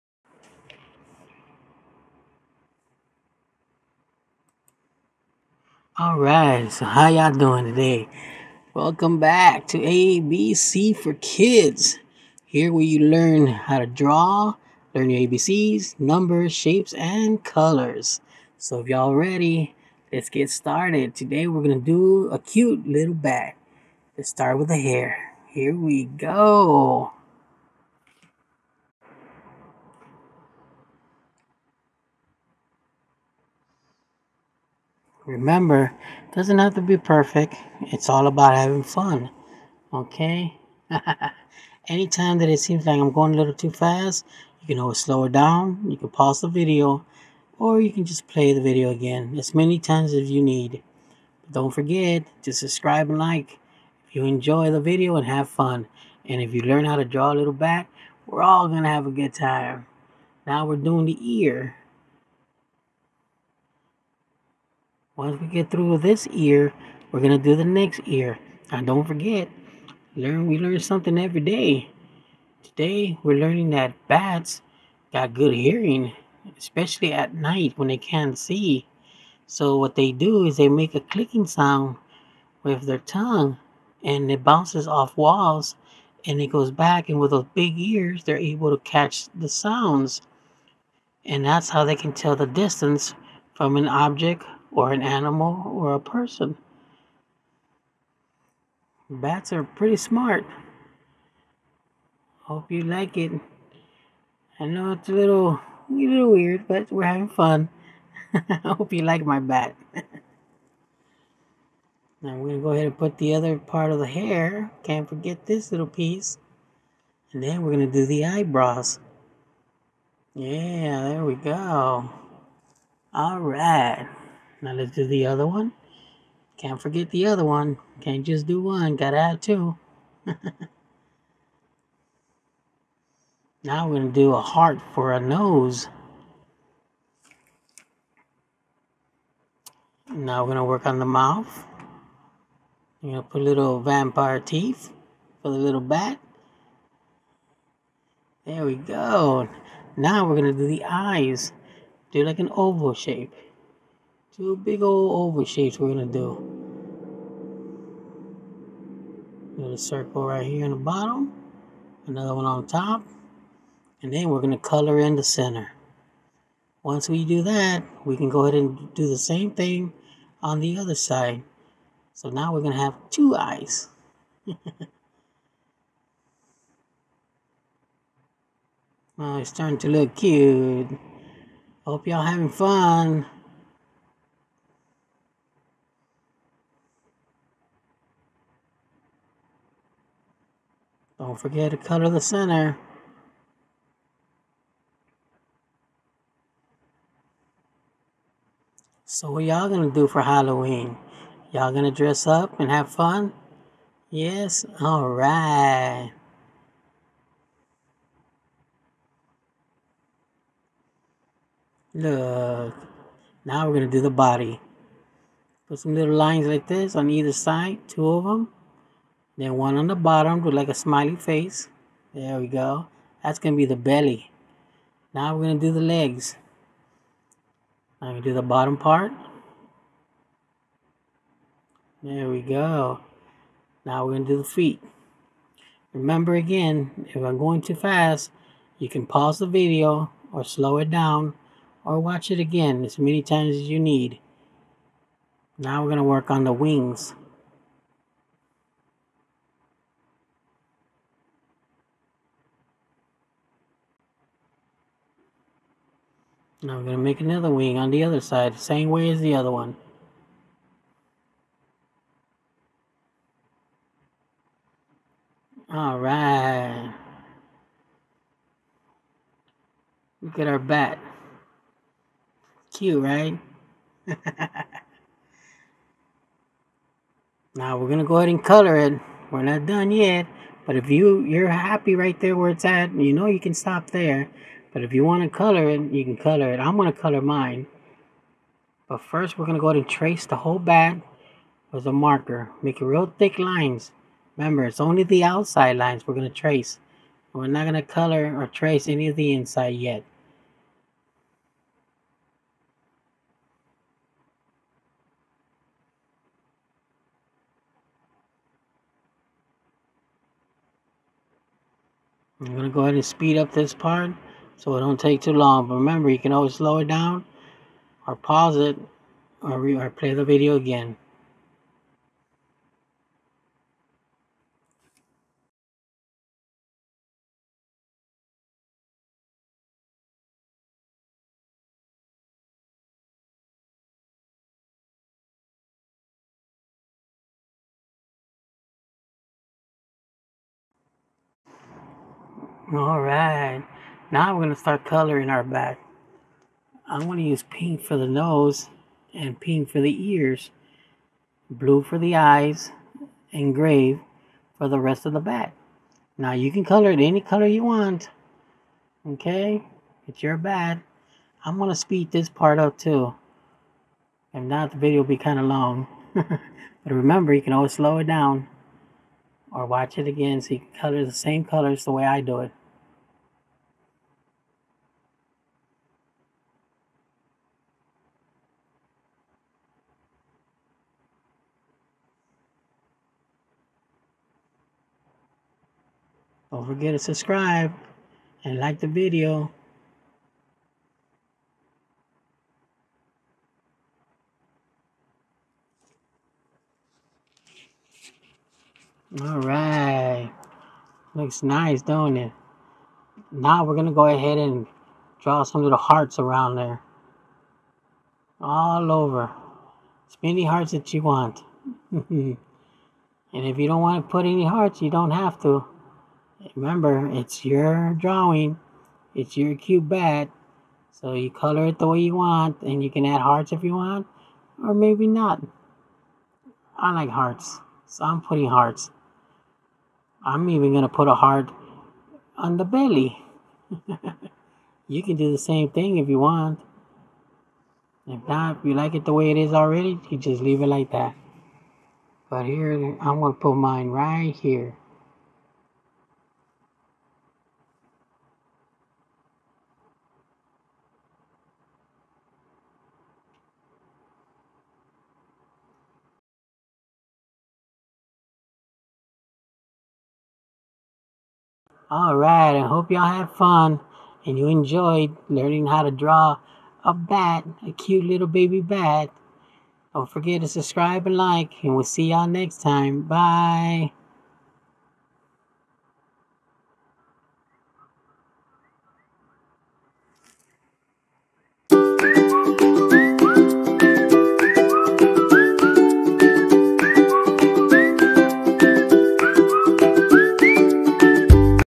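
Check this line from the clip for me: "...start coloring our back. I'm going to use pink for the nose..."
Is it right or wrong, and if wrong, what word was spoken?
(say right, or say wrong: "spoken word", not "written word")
right.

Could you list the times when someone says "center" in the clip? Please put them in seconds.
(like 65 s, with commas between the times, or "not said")
165 s, 192 s.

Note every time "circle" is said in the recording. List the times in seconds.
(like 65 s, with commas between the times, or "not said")
159 s.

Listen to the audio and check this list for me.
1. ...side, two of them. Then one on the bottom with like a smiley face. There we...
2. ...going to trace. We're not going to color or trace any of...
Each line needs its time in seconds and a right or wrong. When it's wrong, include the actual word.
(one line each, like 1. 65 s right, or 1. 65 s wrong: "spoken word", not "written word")
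1. 217 s right
2. 296 s right.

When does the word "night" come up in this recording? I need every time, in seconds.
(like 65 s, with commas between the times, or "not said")
77 s.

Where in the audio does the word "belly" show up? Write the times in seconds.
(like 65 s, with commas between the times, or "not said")
223 s, 432 s.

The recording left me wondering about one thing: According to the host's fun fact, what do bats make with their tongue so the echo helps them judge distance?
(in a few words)
a clicking sound.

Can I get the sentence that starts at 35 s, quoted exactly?
Remember, it doesn't have to be perfect.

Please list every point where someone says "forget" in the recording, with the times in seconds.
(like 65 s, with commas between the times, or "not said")
51 s, 69 s, 115 s, 126 s, 191 s, 386 s, 470 s.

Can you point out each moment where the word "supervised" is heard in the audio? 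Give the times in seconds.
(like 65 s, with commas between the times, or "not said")
not said.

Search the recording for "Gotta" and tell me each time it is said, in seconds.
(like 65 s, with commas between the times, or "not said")
128 s.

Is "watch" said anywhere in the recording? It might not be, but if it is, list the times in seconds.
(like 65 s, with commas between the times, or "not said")
241 s, 369 s.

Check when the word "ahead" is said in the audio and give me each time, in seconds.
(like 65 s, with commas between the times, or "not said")
112 s, 168 s, 278 s, 289 s, 312 s, 404 s.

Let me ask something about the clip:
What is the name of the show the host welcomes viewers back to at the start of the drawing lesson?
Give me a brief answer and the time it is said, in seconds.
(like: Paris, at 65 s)
ABC for Kids, at 9 s.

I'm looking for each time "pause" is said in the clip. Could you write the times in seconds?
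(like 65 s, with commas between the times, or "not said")
46 s, 239 s, 318 s.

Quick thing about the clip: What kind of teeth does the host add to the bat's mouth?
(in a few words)
vampire teeth.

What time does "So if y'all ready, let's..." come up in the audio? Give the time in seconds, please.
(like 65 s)
18 s.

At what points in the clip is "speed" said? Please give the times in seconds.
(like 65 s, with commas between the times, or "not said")
313 s, 361 s.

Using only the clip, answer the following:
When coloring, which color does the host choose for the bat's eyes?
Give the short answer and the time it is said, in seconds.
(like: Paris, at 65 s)
blue, at 351 s.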